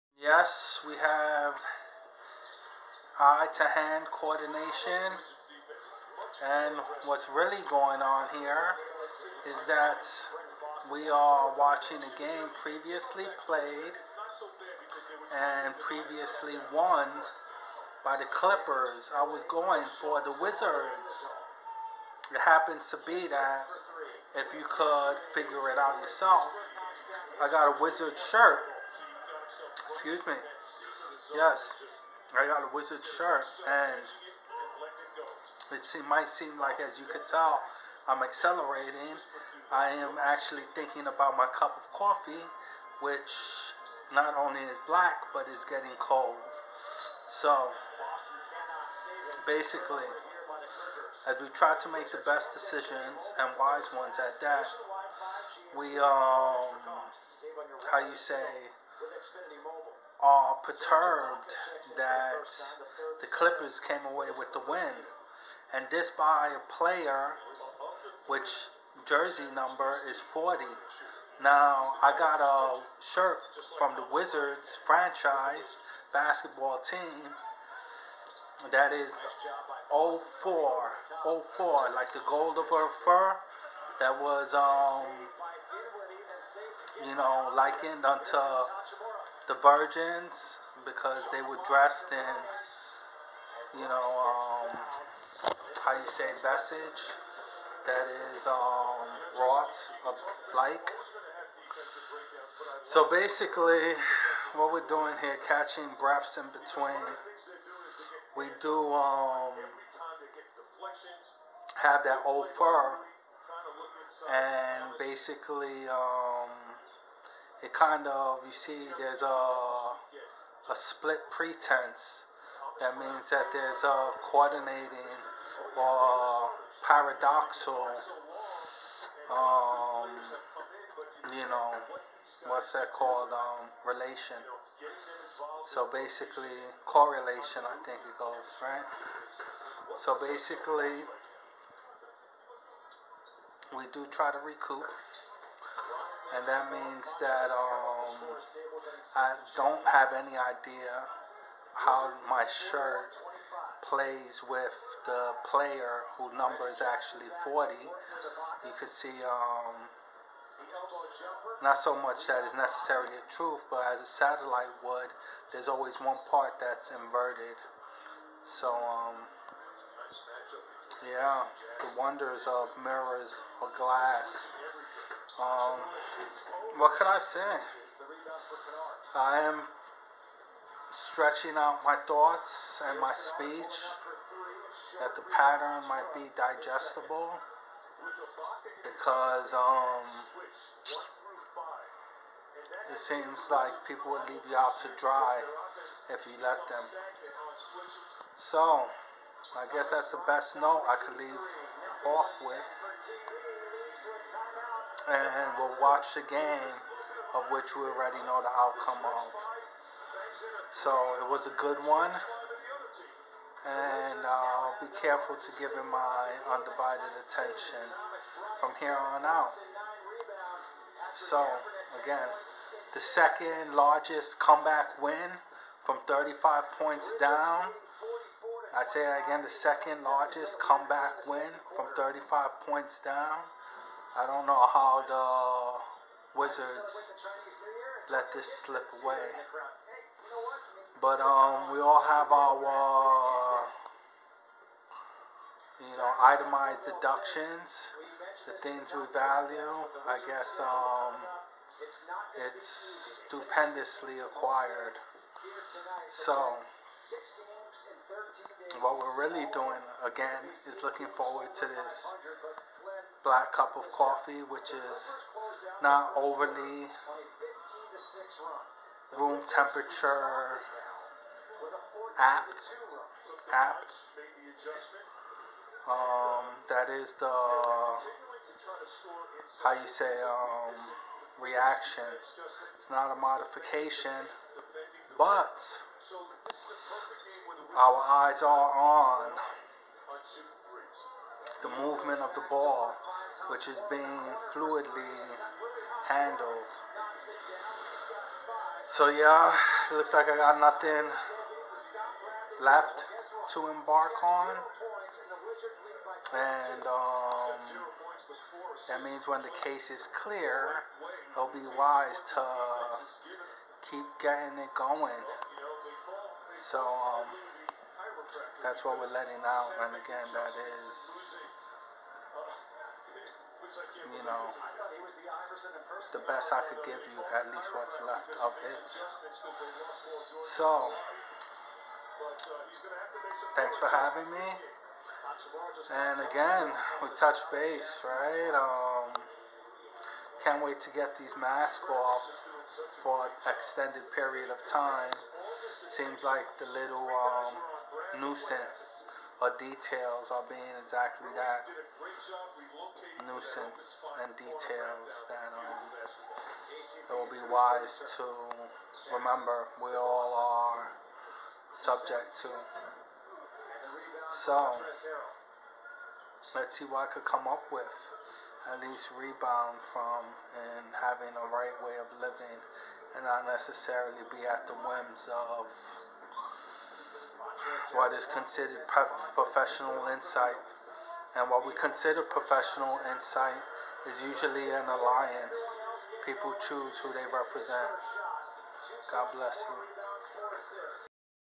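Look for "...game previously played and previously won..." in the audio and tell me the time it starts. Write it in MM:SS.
00:12.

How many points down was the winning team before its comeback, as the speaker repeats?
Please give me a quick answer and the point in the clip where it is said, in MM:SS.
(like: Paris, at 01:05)
35, at 03:51.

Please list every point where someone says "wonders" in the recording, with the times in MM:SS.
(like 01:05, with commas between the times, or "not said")
02:51.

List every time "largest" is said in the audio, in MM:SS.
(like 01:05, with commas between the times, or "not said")
03:43, 03:50.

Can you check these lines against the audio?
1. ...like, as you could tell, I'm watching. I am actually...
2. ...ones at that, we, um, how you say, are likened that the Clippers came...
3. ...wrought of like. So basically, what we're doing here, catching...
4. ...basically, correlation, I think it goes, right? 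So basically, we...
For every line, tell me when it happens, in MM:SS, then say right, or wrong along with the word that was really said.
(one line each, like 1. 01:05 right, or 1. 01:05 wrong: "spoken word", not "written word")
1. 00:36 wrong: "accelerating", not "watching"
2. 00:53 wrong: "perturbed", not "likened"
3. 01:39 right
4. 02:15 right.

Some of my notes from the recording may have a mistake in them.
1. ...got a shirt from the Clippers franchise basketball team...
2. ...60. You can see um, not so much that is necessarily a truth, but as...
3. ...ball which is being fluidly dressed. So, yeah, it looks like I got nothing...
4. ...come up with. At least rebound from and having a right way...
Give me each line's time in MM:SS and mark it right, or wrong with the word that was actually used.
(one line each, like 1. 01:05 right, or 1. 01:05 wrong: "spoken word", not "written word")
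1. 01:12 wrong: "Wizards", not "Clippers"
2. 02:37 wrong: "40", not "60"
3. 04:52 wrong: "handled", not "dressed"
4. 06:07 right.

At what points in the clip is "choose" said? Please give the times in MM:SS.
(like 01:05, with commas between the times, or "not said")
06:26.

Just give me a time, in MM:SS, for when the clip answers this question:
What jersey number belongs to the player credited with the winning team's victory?
01:09.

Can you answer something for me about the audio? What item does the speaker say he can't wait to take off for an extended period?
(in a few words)
masks.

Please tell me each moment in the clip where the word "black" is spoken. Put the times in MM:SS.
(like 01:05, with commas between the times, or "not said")
00:44, 04:23.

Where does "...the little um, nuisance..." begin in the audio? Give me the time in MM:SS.
05:46.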